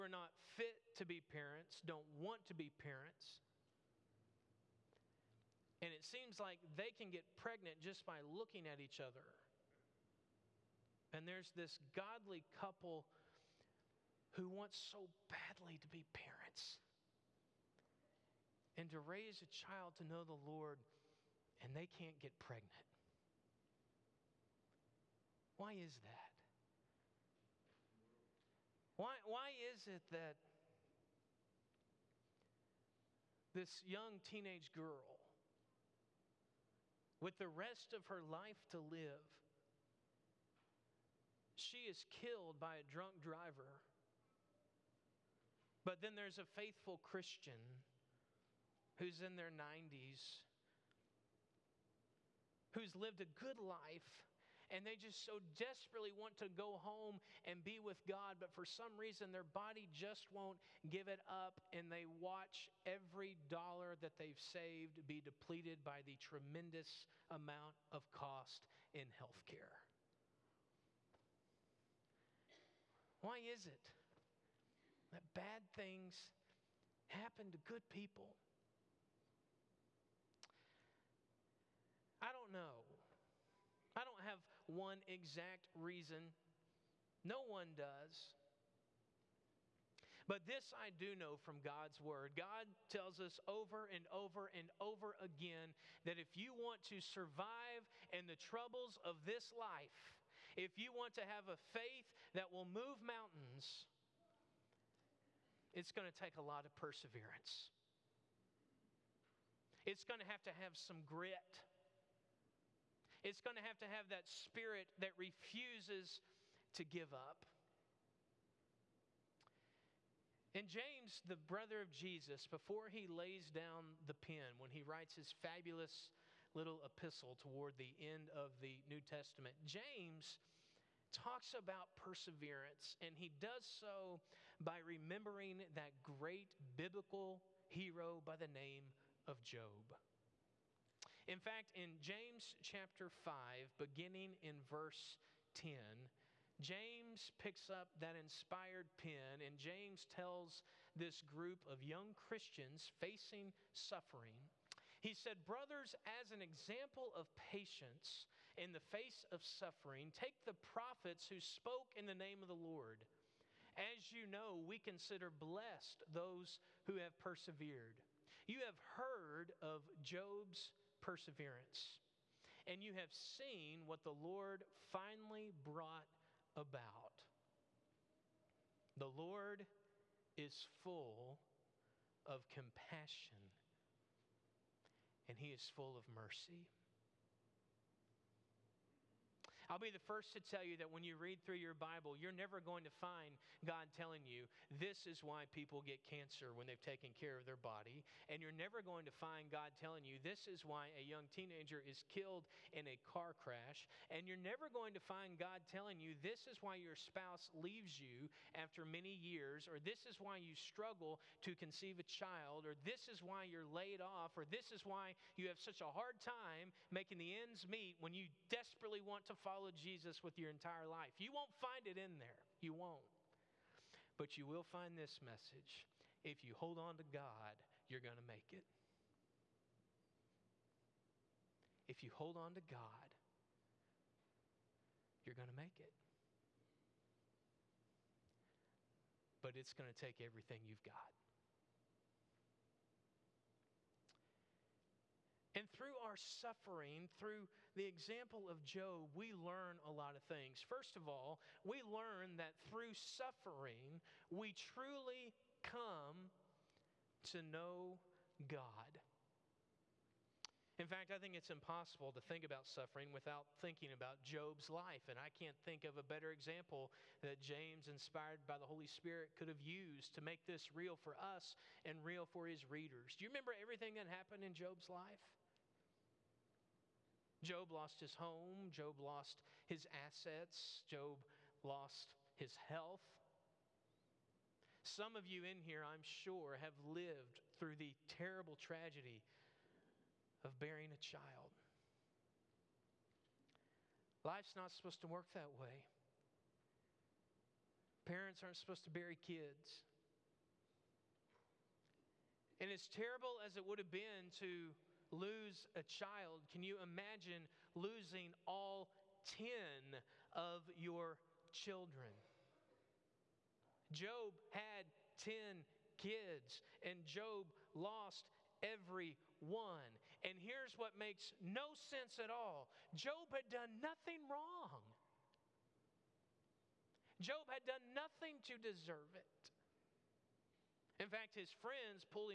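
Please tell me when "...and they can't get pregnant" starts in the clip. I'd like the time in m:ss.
0:21.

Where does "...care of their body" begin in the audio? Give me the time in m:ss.
3:17.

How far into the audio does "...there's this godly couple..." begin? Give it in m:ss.
0:11.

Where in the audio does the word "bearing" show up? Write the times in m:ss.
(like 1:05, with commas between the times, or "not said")
4:50.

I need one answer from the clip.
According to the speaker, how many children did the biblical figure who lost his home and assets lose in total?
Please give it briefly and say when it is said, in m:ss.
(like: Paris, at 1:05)
10, at 5:08.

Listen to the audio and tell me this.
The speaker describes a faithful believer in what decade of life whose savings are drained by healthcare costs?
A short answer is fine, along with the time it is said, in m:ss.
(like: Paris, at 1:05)
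Their 90s, at 0:49.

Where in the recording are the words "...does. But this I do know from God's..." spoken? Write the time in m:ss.
1:27.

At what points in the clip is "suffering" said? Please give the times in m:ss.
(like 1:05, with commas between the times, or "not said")
2:33, 2:39, 4:06, 4:12, 4:22.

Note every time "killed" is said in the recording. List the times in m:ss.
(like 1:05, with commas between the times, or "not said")
0:42, 3:22.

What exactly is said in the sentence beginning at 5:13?
Job had 10 kids, and Job lost every one.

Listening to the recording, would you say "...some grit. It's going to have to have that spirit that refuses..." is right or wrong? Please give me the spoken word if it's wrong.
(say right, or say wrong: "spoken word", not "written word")
right.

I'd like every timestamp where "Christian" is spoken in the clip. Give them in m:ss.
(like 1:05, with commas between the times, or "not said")
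0:46, 2:32.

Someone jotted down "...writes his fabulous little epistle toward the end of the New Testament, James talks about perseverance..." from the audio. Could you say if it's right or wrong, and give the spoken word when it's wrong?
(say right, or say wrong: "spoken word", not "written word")
right.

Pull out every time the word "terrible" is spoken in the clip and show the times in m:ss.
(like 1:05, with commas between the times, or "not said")
4:48, 5:02.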